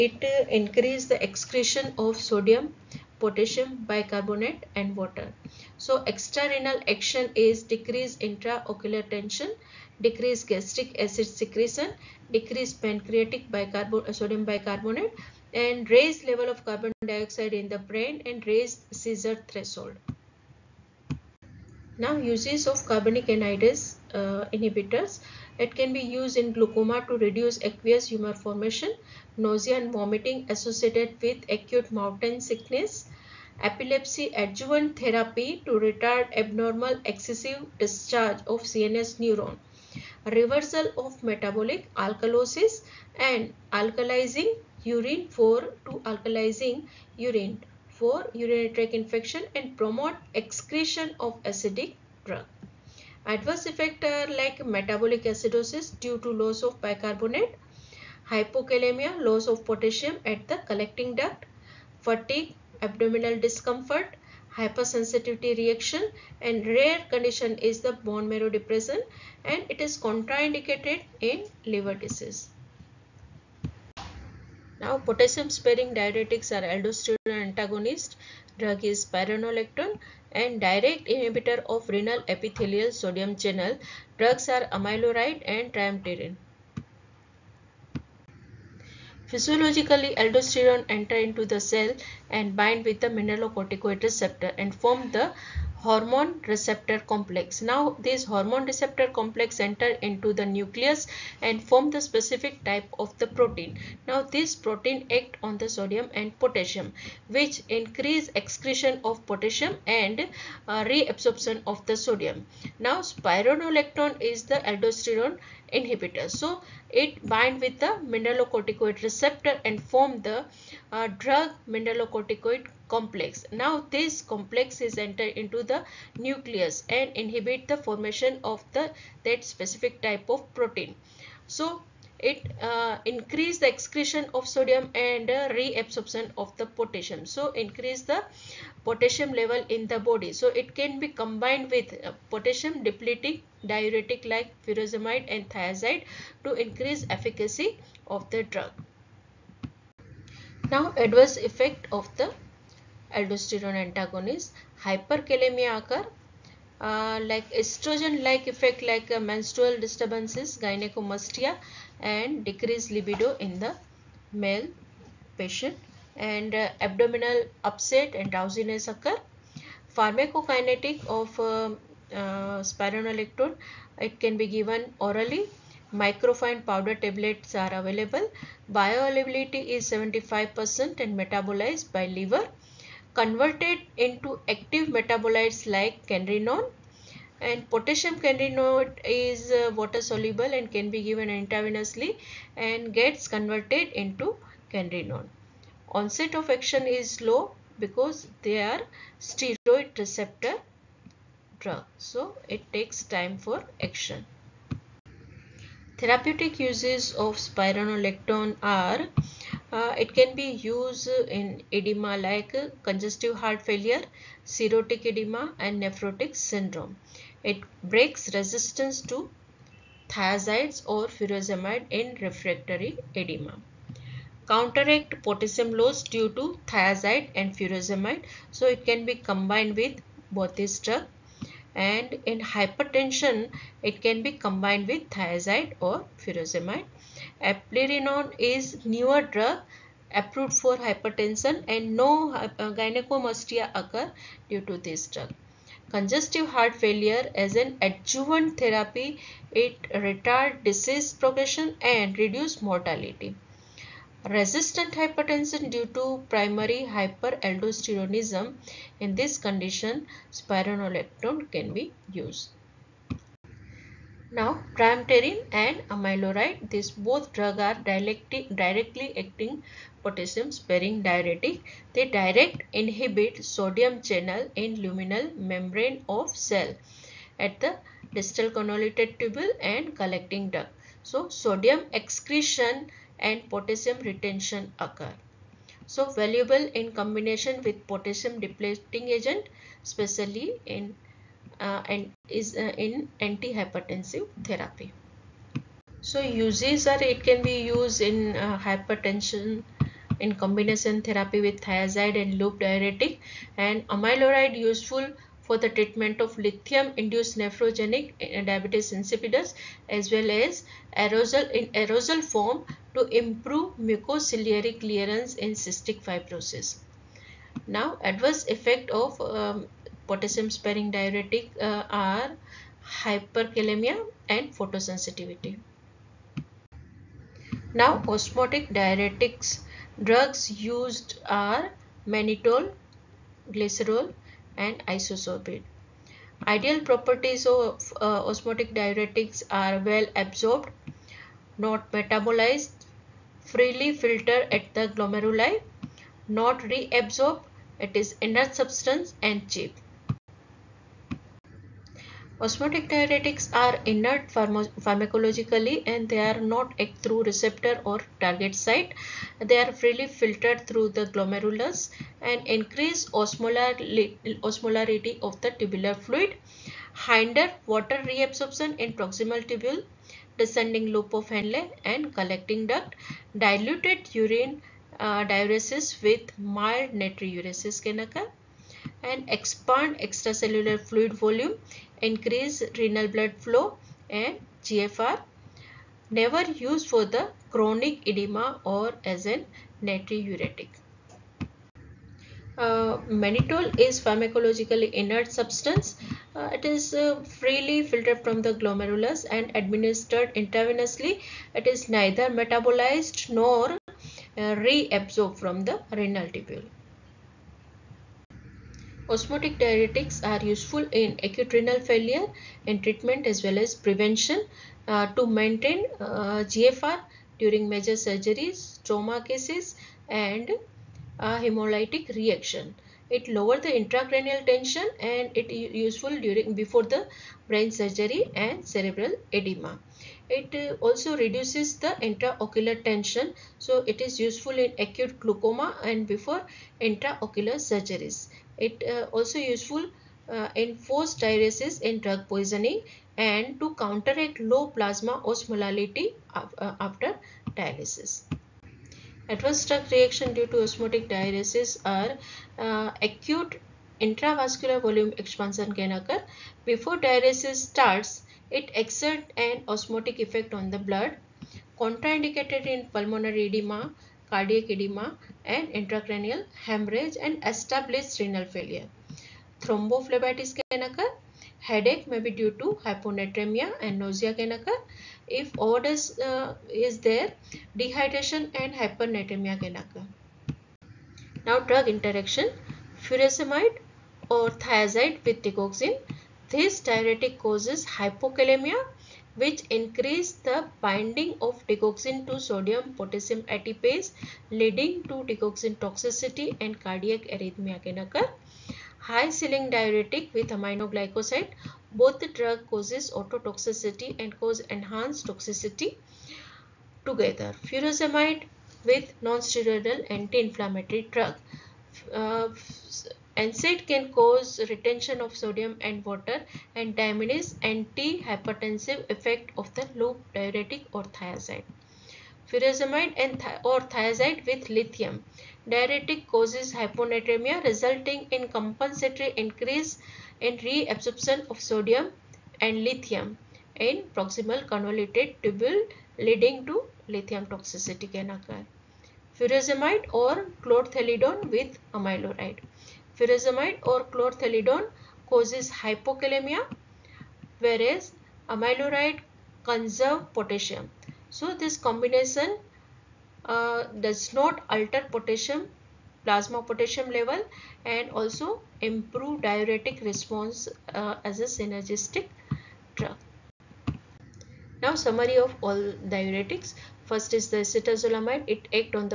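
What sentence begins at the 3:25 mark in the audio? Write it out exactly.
Therapeutic uses of spironolactone are uh, it can be used in edema like congestive heart failure, cirrhotic edema and nephrotic syndrome.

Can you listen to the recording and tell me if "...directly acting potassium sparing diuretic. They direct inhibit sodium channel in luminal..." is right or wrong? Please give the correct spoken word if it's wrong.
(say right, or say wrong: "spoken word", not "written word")
right.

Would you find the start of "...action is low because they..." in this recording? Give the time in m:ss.
3:16.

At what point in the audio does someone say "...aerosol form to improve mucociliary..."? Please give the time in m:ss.
5:11.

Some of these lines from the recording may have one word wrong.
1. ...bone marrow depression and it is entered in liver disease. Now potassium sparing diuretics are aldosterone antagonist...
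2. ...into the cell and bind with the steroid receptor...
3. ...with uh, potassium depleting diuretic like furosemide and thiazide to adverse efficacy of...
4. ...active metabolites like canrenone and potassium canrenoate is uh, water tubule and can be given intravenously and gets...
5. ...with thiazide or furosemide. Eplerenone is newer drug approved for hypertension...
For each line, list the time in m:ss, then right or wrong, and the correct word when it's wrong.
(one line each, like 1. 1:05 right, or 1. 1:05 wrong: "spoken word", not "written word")
1. 1:08 wrong: "contraindicated", not "entered"
2. 1:31 wrong: "mineralocorticoid", not "steroid"
3. 2:21 wrong: "increase", not "adverse"
4. 3:04 wrong: "soluble", not "tubule"
5. 3:54 right.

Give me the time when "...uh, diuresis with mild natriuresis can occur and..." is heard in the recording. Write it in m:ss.
6:14.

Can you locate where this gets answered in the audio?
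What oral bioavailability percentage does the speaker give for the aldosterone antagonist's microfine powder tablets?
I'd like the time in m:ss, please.
2:59.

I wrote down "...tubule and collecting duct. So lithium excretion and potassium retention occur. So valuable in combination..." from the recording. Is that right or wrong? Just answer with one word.
wrong.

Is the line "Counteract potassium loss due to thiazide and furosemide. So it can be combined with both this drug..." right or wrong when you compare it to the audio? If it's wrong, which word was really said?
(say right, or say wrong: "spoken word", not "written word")
right.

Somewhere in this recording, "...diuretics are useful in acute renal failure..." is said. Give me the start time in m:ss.
6:49.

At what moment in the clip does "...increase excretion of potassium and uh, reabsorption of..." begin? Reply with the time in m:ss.
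1:47.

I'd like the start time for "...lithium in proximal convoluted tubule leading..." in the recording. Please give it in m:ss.
8:52.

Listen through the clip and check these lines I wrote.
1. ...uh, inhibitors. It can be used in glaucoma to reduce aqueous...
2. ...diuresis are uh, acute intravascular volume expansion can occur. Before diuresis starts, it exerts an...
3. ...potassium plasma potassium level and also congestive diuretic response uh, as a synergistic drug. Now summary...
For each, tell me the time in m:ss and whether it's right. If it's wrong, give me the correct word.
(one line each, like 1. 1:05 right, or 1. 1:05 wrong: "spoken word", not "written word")
1. 0:24 right
2. 7:31 right
3. 9:15 wrong: "improve", not "congestive".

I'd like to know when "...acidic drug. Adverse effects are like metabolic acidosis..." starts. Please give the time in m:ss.
0:51.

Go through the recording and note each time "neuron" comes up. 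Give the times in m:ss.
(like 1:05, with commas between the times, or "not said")
0:39.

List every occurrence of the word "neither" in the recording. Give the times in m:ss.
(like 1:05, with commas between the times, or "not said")
6:41.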